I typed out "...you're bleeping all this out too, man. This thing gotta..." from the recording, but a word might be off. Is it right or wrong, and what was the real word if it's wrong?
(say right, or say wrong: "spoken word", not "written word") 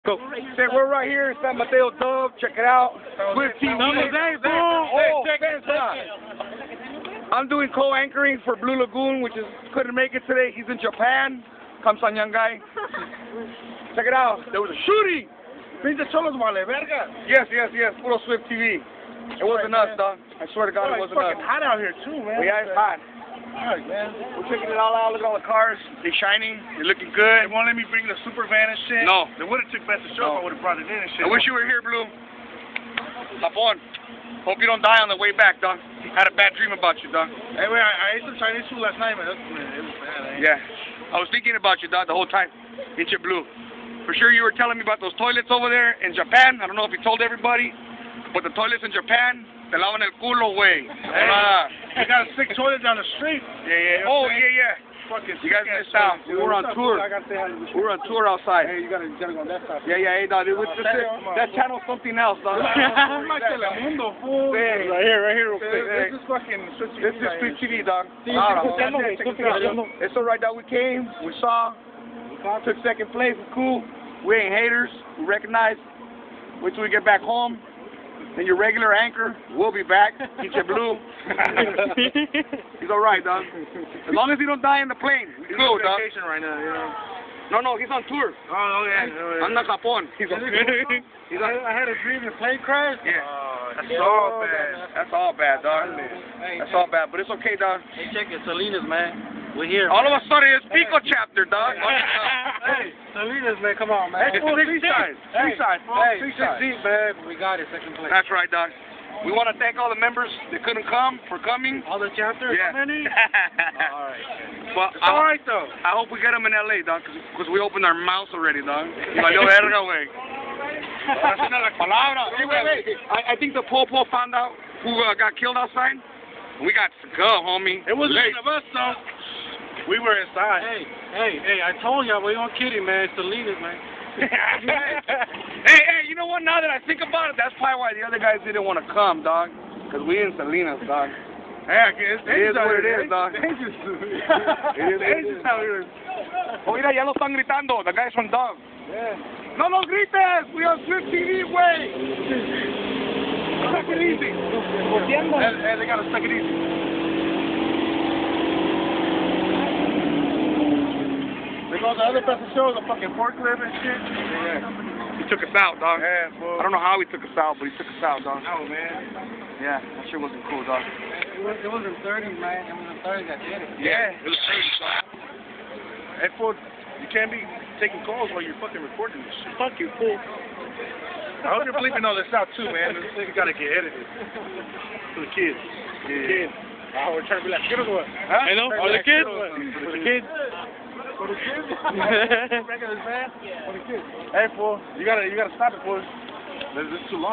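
right.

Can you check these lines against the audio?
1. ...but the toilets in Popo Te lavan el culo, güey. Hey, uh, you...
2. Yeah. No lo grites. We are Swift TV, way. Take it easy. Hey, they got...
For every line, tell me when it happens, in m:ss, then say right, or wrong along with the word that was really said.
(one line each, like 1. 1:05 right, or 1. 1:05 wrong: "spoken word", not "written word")
1. 0:48 wrong: "Japan", not "Popo"
2. 2:28 right.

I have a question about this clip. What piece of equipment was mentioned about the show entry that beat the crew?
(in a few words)
Forklift.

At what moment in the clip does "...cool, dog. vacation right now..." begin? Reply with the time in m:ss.
1:25.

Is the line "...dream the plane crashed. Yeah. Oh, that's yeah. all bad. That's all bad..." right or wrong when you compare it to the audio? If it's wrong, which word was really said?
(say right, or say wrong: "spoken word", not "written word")
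right.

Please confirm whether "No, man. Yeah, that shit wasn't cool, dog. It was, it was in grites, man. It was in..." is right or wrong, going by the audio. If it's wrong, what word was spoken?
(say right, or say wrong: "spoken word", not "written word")
wrong: "thirties", not "grites".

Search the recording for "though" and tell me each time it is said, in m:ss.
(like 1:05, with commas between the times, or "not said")
1:55, 2:08.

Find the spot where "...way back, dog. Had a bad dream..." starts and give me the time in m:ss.
0:35.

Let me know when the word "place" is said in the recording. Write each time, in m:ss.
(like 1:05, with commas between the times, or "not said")
1:13, 1:47.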